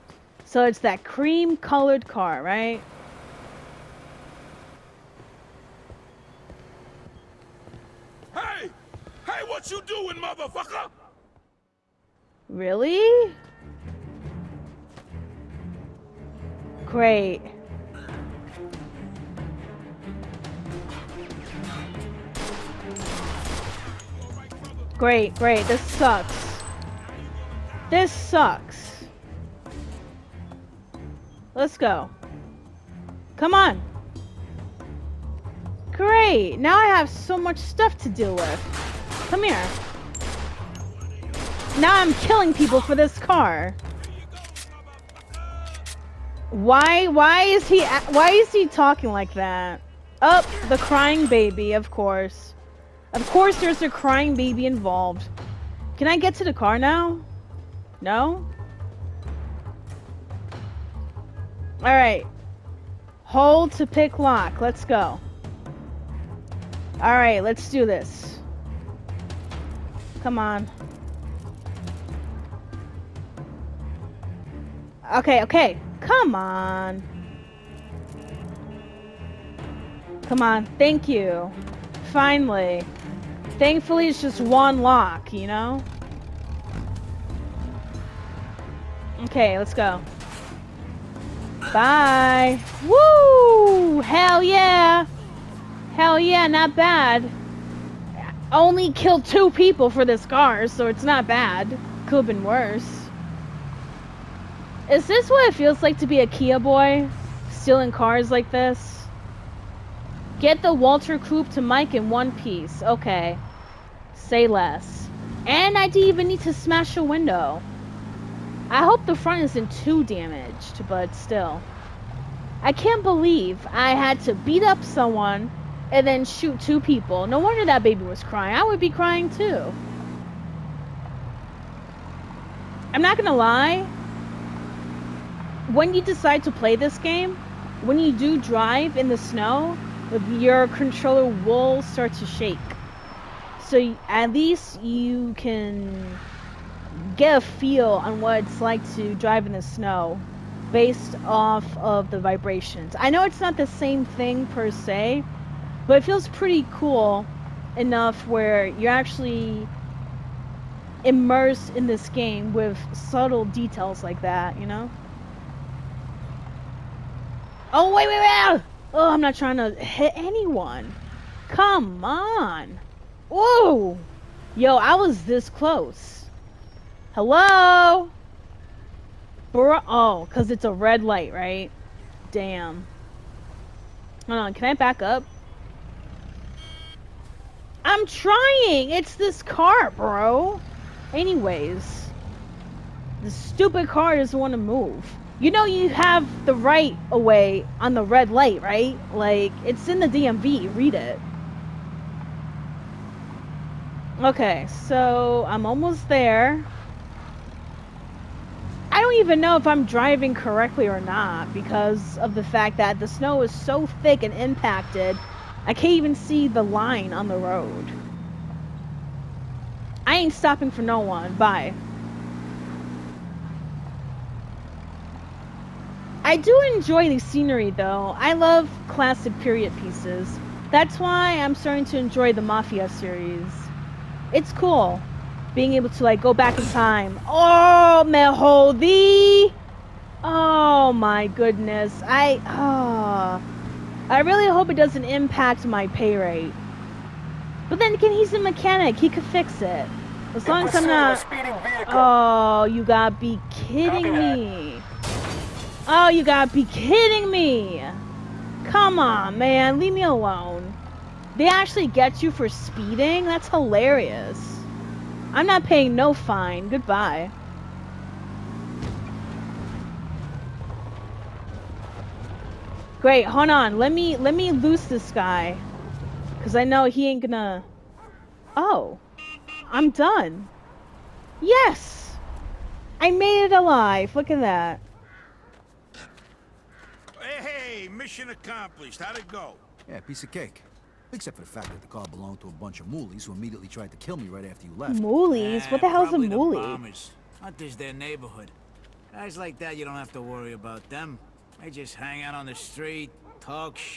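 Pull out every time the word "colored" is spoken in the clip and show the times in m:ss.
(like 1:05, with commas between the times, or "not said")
0:01.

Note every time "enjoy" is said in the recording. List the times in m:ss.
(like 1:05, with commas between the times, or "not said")
3:46, 3:51.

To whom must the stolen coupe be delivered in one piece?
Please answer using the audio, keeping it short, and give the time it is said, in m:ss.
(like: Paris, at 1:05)
Mike, at 1:51.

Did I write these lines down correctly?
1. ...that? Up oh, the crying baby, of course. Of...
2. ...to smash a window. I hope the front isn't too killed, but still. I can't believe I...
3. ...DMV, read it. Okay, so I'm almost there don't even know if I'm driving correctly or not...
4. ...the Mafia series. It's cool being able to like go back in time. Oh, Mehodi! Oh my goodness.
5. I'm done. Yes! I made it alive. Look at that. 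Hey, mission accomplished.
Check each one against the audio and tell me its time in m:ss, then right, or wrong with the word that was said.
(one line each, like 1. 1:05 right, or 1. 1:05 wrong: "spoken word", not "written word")
1. 0:49 right
2. 1:56 wrong: "damaged", not "killed"
3. 3:20 right
4. 3:52 right
5. 4:39 right.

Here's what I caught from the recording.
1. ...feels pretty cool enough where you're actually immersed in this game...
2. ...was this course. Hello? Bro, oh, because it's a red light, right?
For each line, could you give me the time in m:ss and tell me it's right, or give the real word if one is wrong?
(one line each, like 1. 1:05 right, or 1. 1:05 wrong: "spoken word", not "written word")
1. 2:36 right
2. 2:54 wrong: "close", not "course".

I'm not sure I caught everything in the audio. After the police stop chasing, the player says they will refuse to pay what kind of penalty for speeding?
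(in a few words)
fine.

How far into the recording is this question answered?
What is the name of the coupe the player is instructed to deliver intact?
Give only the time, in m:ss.
1:50.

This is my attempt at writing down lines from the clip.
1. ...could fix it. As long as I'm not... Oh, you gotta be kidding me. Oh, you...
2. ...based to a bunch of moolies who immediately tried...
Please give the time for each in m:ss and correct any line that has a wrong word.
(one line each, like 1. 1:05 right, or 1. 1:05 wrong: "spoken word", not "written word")
1. 4:09 right
2. 4:52 wrong: "belonged", not "based".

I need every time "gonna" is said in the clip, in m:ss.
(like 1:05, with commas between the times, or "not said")
2:13, 4:37.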